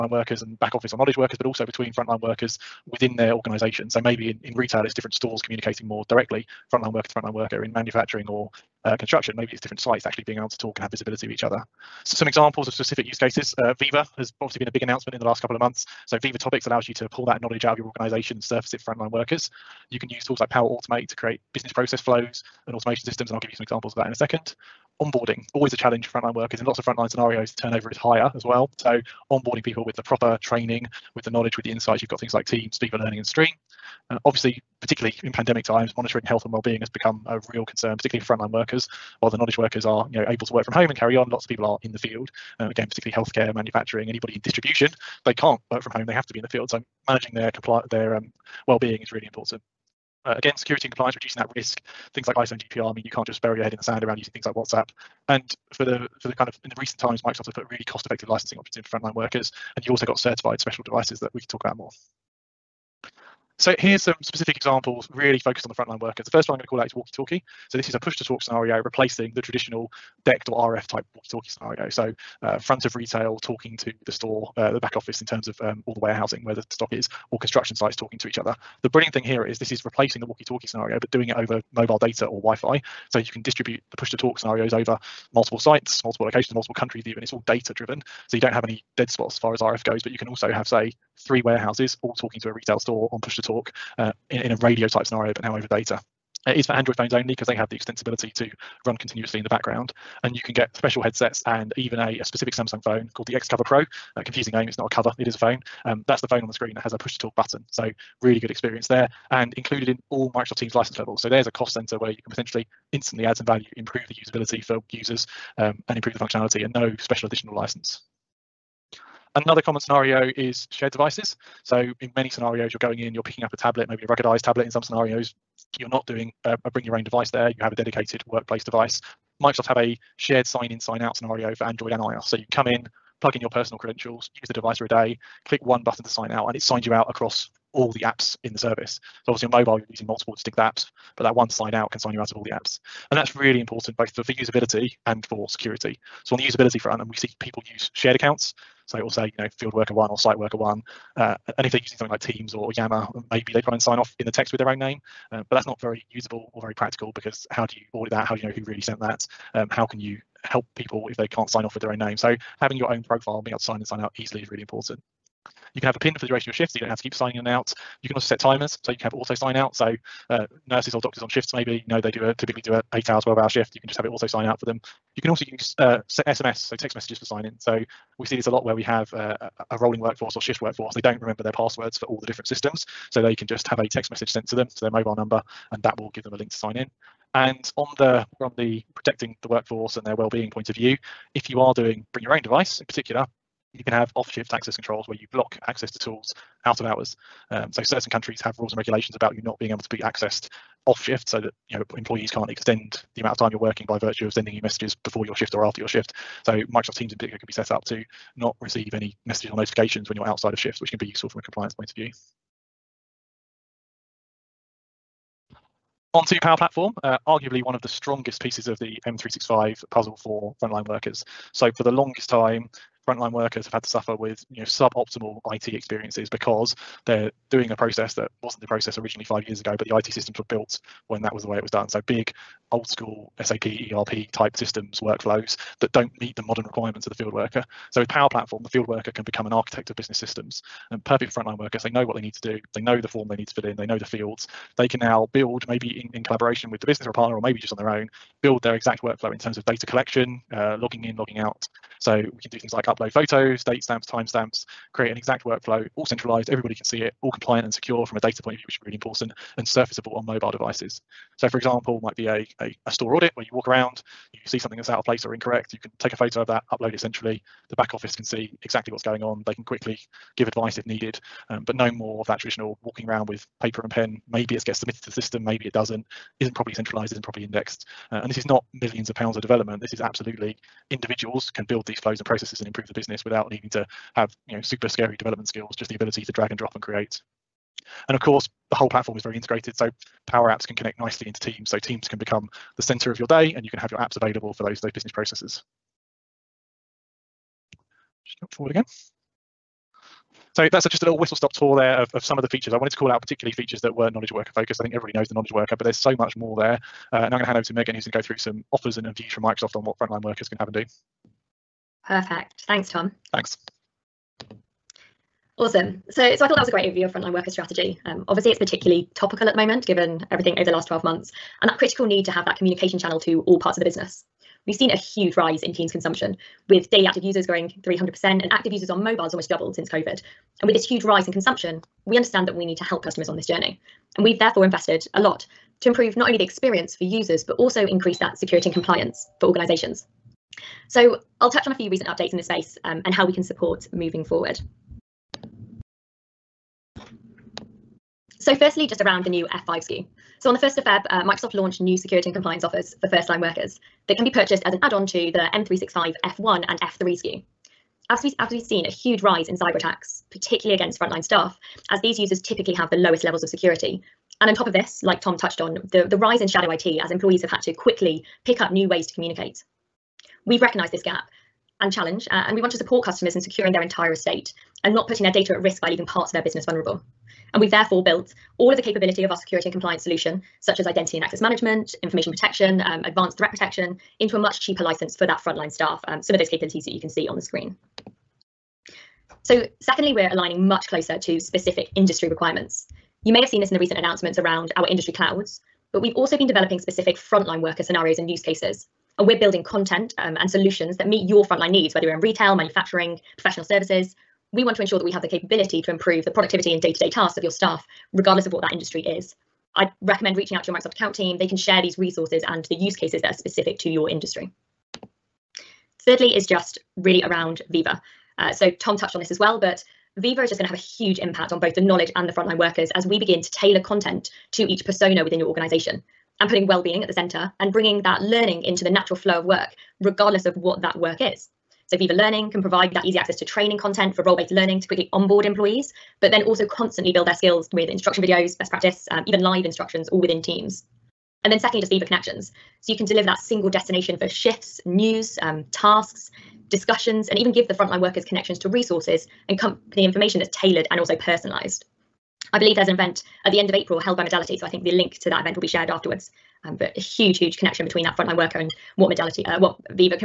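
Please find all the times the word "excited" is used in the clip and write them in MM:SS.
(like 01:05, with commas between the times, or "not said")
not said.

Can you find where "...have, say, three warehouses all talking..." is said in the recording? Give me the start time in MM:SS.
01:30.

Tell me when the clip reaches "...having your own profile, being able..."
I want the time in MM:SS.
02:42.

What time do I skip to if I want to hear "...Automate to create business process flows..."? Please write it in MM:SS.
00:20.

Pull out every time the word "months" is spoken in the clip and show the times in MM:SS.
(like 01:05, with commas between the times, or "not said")
00:15, 05:21.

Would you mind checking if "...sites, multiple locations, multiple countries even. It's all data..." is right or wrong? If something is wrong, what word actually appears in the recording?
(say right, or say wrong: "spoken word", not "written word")
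right.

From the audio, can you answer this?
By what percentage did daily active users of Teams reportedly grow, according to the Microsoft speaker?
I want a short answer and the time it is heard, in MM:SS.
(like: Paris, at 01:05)
300%, at 05:27.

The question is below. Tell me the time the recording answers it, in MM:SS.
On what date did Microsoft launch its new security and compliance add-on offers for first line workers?
05:50.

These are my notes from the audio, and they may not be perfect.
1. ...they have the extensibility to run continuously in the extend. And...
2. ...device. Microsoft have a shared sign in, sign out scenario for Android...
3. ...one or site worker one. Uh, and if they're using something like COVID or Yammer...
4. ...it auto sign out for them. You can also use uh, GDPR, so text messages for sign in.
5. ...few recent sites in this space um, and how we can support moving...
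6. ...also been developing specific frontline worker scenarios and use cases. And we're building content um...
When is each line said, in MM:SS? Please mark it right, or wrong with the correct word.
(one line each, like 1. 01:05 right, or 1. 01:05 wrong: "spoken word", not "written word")
1. 01:37 wrong: "background", not "extend"
2. 02:08 right
3. 02:29 wrong: "Teams", not "COVID"
4. 02:54 wrong: "SMS", not "GDPR"
5. 05:41 wrong: "updates", not "sites"
6. 06:36 right.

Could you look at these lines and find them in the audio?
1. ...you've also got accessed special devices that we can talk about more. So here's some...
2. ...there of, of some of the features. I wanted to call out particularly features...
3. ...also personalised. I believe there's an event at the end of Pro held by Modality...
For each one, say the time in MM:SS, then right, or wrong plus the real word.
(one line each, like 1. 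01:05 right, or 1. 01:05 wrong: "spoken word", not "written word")
1. 00:59 wrong: "certified", not "accessed"
2. 05:01 right
3. 07:30 wrong: "April", not "Pro".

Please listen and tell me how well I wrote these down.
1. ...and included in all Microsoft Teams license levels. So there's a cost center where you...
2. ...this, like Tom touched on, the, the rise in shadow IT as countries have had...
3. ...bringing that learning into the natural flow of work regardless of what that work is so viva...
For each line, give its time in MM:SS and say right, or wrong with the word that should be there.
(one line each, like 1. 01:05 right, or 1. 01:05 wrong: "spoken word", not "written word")
1. 01:49 right
2. 06:04 wrong: "employees", not "countries"
3. 07:07 right.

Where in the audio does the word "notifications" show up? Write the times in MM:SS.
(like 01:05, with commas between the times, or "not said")
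03:29.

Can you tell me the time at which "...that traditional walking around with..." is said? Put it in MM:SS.
04:32.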